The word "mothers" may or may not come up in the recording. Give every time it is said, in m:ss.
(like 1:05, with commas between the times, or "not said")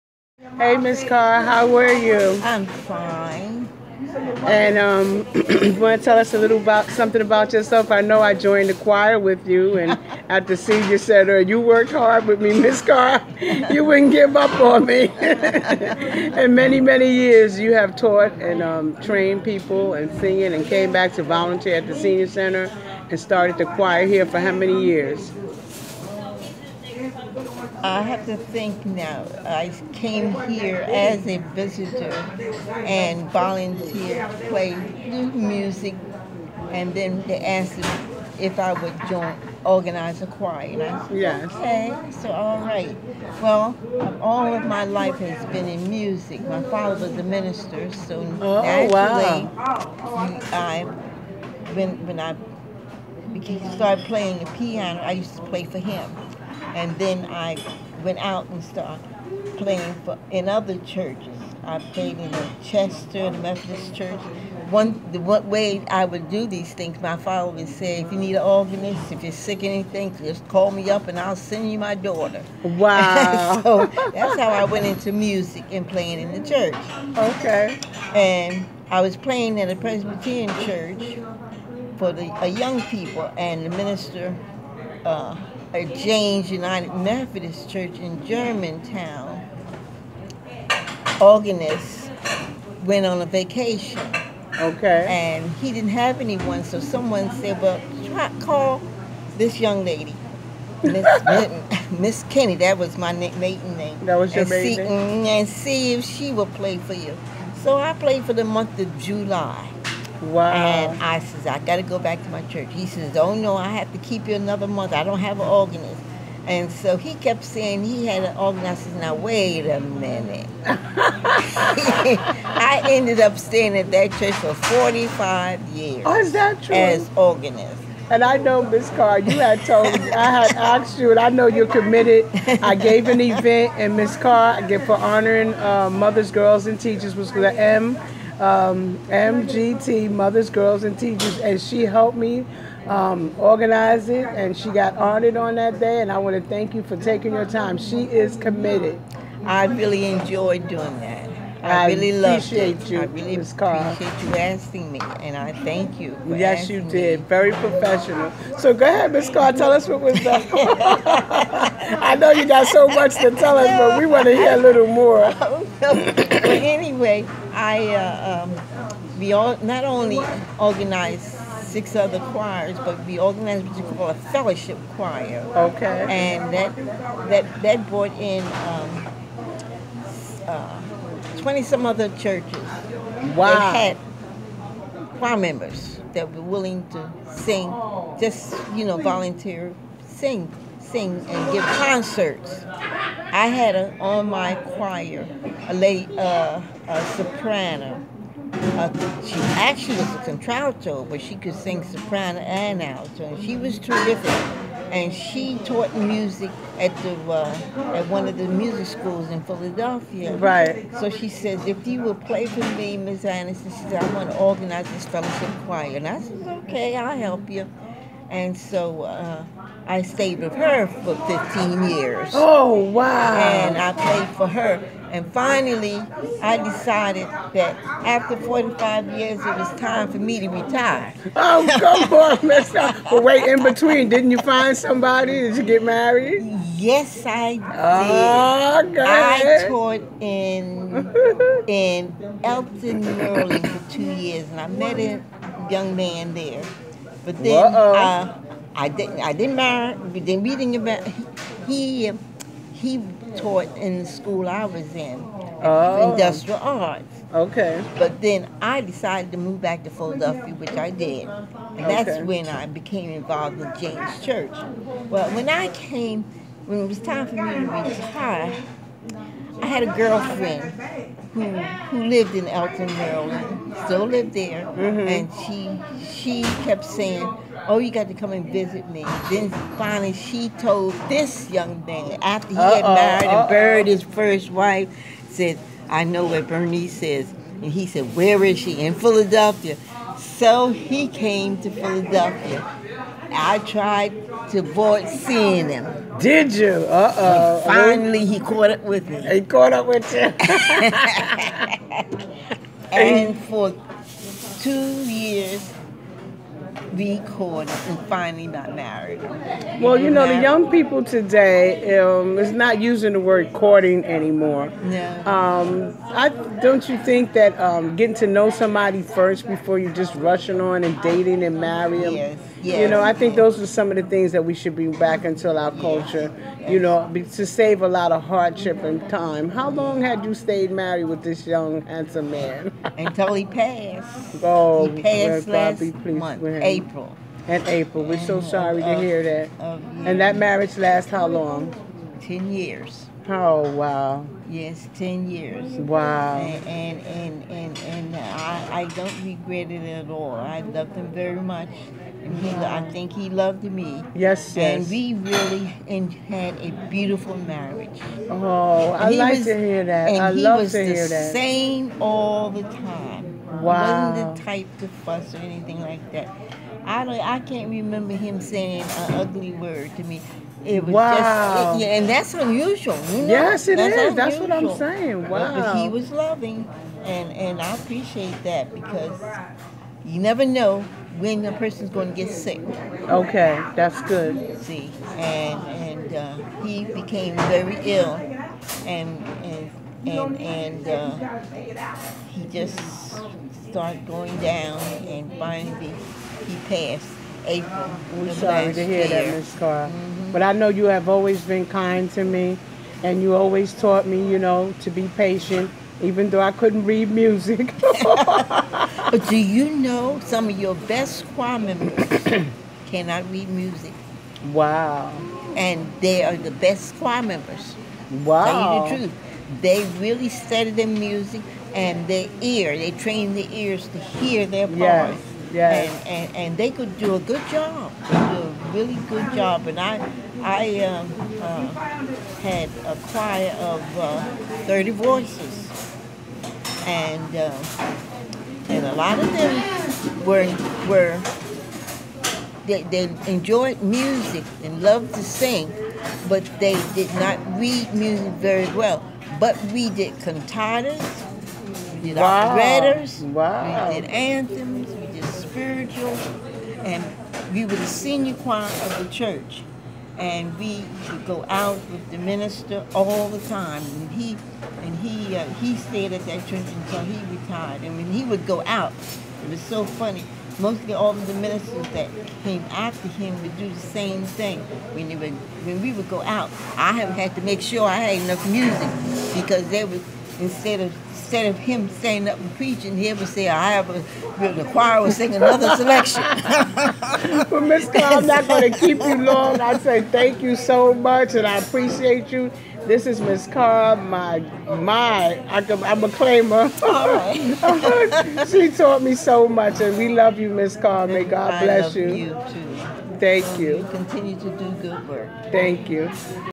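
2:15, 2:20.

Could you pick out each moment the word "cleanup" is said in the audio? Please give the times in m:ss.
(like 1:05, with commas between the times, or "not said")
not said.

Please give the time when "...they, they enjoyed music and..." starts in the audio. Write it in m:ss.
7:22.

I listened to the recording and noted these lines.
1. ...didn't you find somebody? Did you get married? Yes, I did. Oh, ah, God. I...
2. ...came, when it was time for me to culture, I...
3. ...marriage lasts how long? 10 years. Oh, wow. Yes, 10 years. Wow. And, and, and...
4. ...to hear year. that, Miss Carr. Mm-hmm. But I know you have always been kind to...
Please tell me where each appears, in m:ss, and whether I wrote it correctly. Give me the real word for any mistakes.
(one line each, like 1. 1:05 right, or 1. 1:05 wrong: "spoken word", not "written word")
1. 3:54 right
2. 4:25 wrong: "retire", not "culture"
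3. 5:40 right
4. 6:38 right.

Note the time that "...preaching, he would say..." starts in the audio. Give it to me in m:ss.
8:02.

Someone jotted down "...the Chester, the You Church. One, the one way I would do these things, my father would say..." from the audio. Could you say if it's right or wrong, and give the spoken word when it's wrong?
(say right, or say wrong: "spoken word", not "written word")
wrong: "Methodist", not "You".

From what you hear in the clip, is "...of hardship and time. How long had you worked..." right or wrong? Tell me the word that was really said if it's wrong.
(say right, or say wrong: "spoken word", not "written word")
wrong: "stayed", not "worked".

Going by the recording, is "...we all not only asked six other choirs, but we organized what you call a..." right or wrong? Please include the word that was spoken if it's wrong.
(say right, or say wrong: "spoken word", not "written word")
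wrong: "organized", not "asked".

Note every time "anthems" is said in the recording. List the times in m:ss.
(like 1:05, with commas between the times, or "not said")
7:34.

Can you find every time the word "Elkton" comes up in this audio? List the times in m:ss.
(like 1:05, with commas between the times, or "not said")
4:02, 4:32.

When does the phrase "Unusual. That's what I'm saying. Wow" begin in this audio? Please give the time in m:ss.
6:14.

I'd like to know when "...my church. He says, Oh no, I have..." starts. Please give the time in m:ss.
1:52.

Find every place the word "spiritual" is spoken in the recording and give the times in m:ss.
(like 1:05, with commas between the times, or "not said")
7:35.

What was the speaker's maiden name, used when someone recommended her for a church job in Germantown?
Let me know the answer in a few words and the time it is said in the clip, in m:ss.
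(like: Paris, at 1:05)
Kenny, at 1:42.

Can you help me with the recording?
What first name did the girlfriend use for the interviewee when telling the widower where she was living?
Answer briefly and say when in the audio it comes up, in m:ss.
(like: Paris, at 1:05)
Bernice, at 4:46.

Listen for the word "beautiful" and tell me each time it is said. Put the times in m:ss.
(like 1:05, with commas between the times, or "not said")
5:56.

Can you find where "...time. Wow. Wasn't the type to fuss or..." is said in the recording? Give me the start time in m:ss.
6:02.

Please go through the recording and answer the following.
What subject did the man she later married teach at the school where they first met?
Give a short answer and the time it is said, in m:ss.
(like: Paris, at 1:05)
Industrial arts, at 4:16.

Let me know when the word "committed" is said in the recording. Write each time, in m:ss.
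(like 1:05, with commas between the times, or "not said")
2:11, 2:28.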